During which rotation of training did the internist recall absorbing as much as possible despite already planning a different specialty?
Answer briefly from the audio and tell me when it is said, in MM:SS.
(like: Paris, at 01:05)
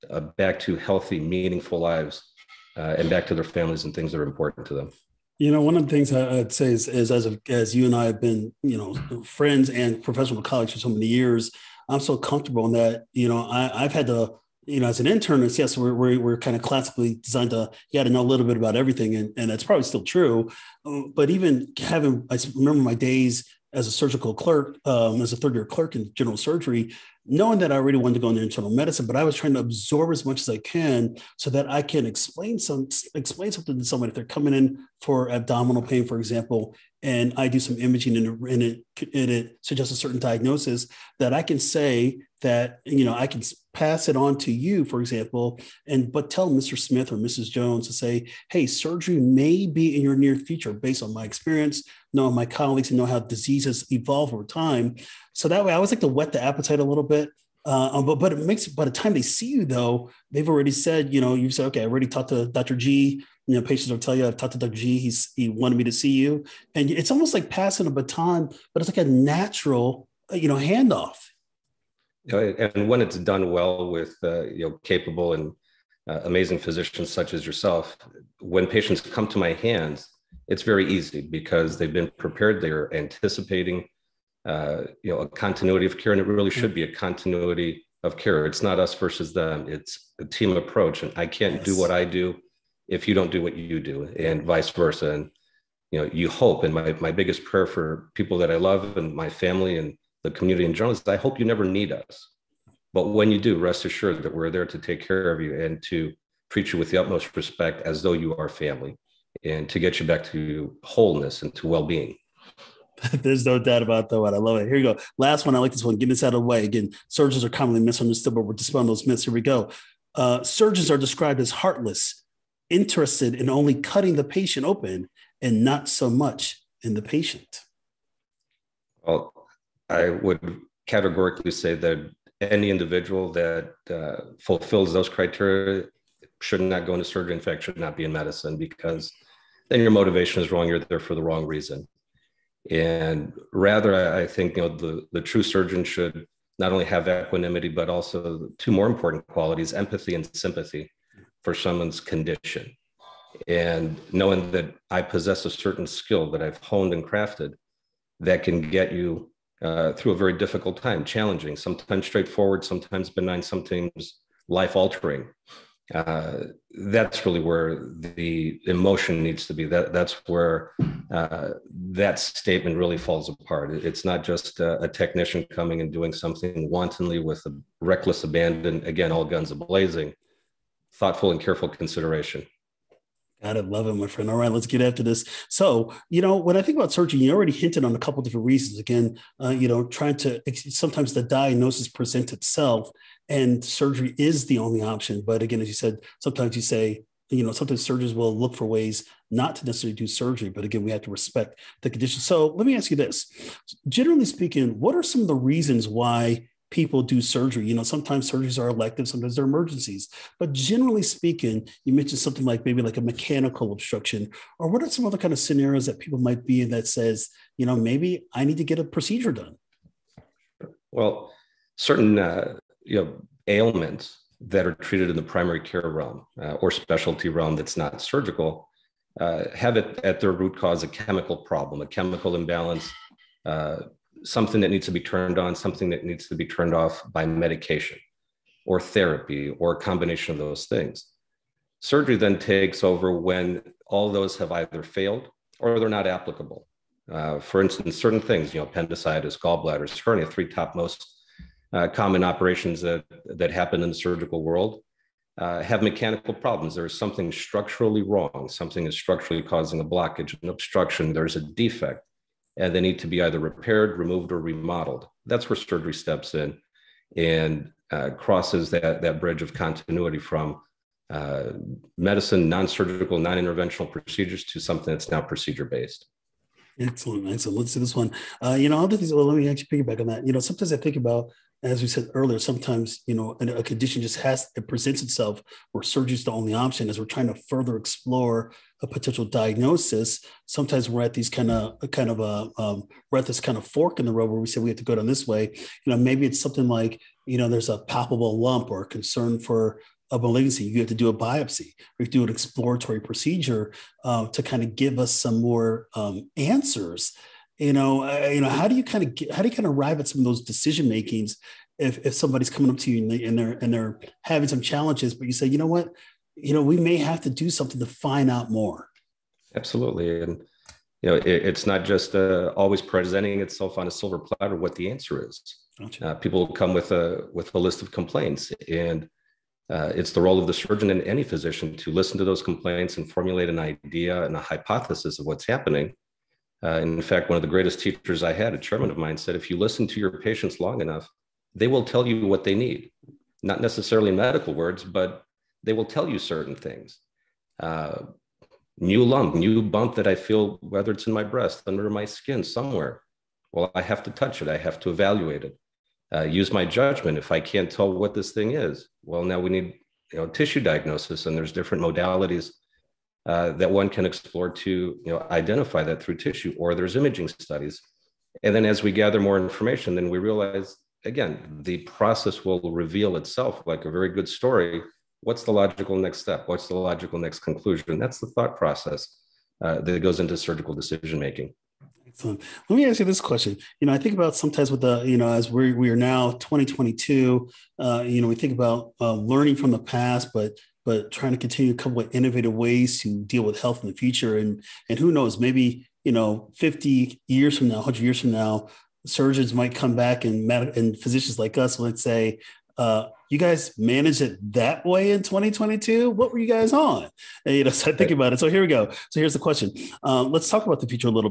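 general surgery, at 00:26.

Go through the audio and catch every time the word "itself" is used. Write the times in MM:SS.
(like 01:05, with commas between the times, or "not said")
03:12, 04:45, 05:23, 06:13.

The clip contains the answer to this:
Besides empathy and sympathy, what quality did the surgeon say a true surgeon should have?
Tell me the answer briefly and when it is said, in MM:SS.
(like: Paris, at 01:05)
equanimity, at 02:27.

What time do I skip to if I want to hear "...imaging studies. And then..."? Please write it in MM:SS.
06:06.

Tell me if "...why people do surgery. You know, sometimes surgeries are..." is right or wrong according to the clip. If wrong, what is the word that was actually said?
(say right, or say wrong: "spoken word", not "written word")
right.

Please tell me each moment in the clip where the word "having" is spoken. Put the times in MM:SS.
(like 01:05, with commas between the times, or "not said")
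00:21, 05:14.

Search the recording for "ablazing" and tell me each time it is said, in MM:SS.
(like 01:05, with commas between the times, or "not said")
02:59.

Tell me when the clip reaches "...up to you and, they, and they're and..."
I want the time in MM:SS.
05:12.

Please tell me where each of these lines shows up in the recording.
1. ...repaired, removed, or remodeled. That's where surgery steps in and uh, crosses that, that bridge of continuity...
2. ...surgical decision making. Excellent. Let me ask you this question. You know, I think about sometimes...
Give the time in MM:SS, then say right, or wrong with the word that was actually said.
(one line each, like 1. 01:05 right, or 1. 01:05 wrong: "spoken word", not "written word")
1. 04:23 right
2. 06:20 right.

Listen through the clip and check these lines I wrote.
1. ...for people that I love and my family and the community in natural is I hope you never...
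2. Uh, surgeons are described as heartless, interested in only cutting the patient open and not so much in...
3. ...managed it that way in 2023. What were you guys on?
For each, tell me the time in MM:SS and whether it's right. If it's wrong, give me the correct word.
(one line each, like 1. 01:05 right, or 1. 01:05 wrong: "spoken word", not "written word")
1. 01:37 wrong: "general", not "natural"
2. 02:00 right
3. 06:43 wrong: "2022", not "2023".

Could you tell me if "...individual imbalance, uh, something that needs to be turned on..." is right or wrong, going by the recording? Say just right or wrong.
wrong.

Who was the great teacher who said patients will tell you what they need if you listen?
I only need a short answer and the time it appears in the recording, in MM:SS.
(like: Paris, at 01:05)
a chairman, at 05:38.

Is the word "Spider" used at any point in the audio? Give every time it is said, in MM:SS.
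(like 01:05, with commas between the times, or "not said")
not said.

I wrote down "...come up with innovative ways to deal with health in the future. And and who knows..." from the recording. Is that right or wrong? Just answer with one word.
right.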